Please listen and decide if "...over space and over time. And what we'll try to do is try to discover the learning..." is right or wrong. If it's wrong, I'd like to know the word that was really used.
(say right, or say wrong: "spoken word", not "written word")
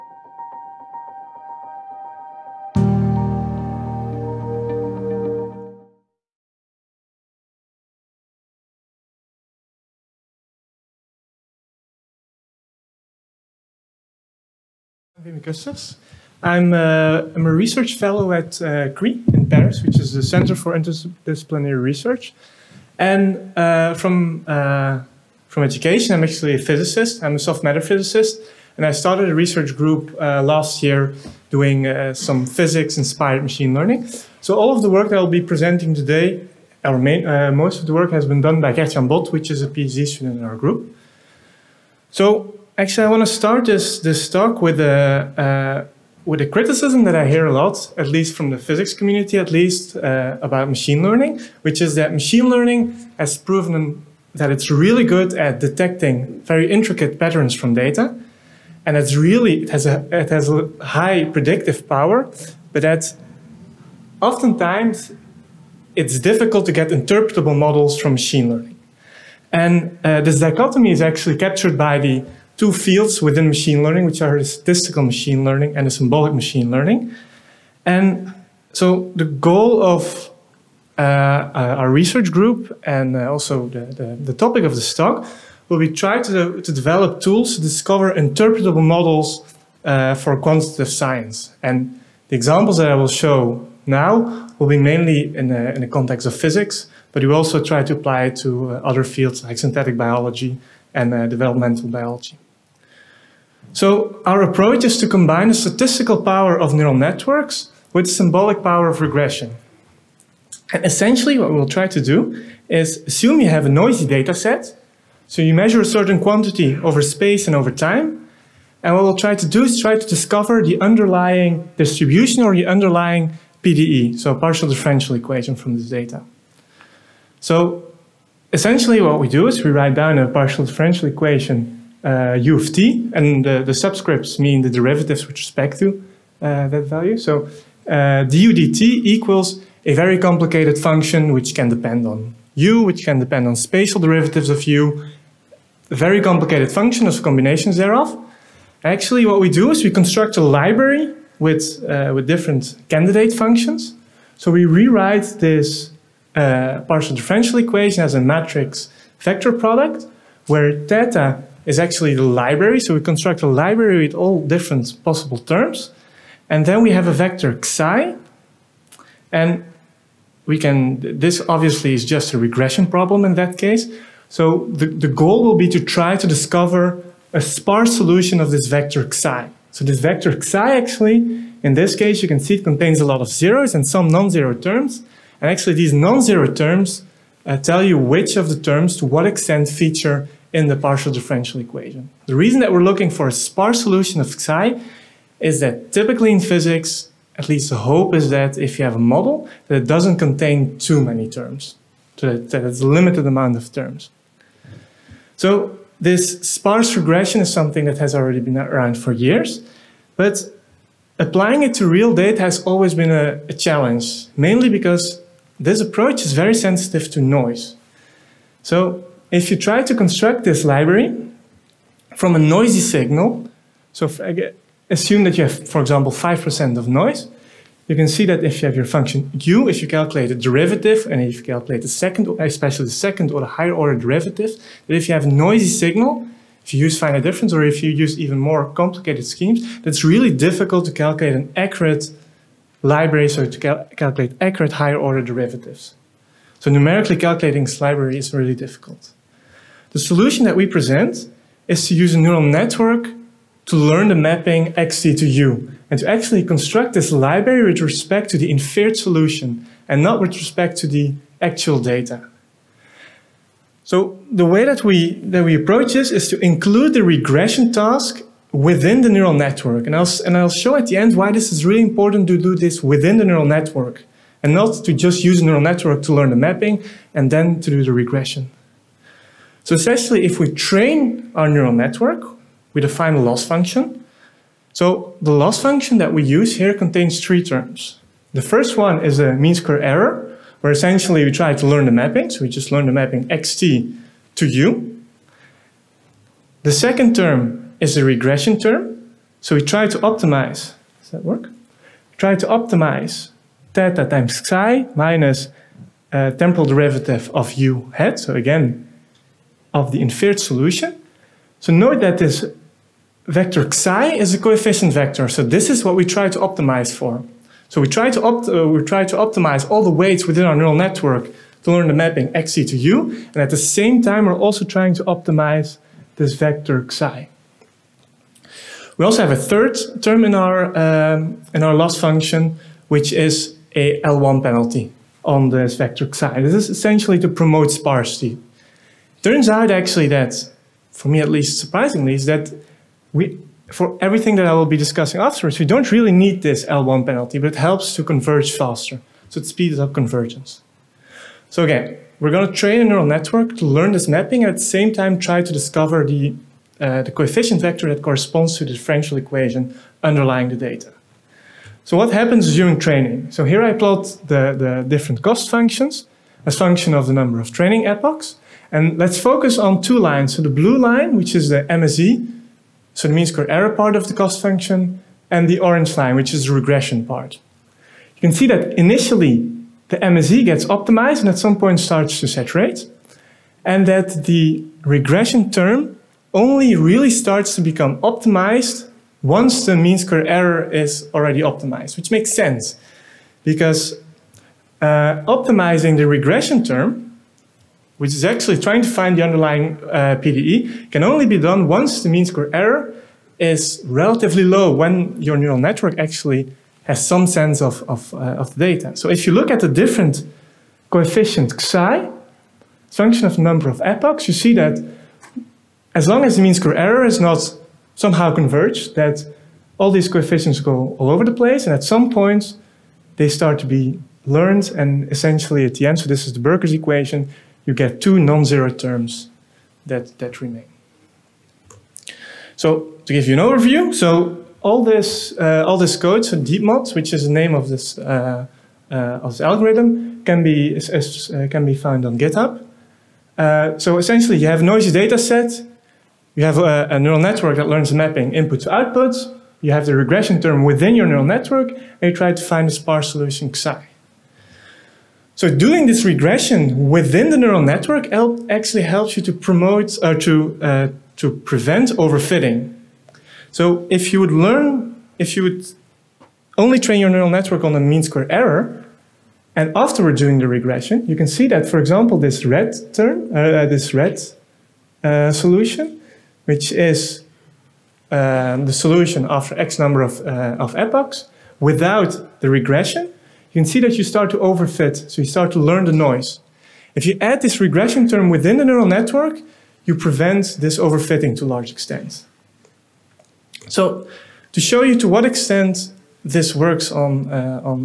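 wrong: "underlying", not "learning".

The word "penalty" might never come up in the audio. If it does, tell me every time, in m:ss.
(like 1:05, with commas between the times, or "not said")
5:34, 5:47.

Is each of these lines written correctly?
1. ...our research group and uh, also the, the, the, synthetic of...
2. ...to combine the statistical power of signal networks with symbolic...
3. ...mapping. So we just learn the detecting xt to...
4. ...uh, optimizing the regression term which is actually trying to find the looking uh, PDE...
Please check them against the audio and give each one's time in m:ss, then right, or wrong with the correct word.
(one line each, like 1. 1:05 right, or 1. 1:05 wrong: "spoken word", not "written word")
1. 1:21 wrong: "topic", not "synthetic"
2. 1:44 wrong: "neural", not "signal"
3. 4:51 wrong: "mapping", not "detecting"
4. 6:34 wrong: "underlying", not "looking".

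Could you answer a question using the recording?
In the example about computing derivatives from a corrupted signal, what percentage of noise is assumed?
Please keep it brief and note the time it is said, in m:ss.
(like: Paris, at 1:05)
5%, at 3:46.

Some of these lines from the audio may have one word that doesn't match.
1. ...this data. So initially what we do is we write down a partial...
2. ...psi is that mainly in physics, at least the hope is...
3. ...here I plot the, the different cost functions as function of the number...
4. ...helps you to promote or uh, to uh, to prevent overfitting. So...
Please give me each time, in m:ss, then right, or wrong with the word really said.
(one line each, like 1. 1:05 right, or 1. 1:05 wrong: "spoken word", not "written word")
1. 2:05 wrong: "essentially", not "initially"
2. 3:14 wrong: "typically", not "mainly"
3. 6:03 right
4. 7:38 right.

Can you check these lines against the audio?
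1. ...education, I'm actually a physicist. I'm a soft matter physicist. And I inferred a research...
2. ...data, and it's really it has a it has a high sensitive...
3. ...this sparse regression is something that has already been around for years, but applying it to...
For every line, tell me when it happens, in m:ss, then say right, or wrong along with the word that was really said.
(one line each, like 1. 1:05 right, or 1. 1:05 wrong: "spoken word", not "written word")
1. 0:25 wrong: "started", not "inferred"
2. 0:57 wrong: "predictive", not "sensitive"
3. 3:25 right.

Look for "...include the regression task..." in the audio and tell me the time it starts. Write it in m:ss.
4:26.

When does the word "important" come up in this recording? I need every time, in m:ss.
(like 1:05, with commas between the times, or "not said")
4:31.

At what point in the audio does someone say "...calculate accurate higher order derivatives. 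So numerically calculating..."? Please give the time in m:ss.
4:03.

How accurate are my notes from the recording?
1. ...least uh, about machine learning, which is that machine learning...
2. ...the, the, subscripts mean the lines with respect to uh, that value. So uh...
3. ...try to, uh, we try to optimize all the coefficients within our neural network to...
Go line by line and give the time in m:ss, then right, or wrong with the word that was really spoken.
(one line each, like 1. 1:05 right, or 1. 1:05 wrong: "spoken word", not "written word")
1. 0:49 right
2. 2:13 wrong: "derivatives", not "lines"
3. 5:17 wrong: "weights", not "coefficients".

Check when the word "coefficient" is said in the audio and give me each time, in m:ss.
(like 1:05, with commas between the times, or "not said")
5:14, 5:57, 6:50, 7:00.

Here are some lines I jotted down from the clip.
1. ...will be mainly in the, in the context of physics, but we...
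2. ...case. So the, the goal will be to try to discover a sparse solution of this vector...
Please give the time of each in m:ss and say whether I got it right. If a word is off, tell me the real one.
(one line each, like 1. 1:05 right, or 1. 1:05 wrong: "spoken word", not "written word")
1. 1:34 right
2. 2:53 right.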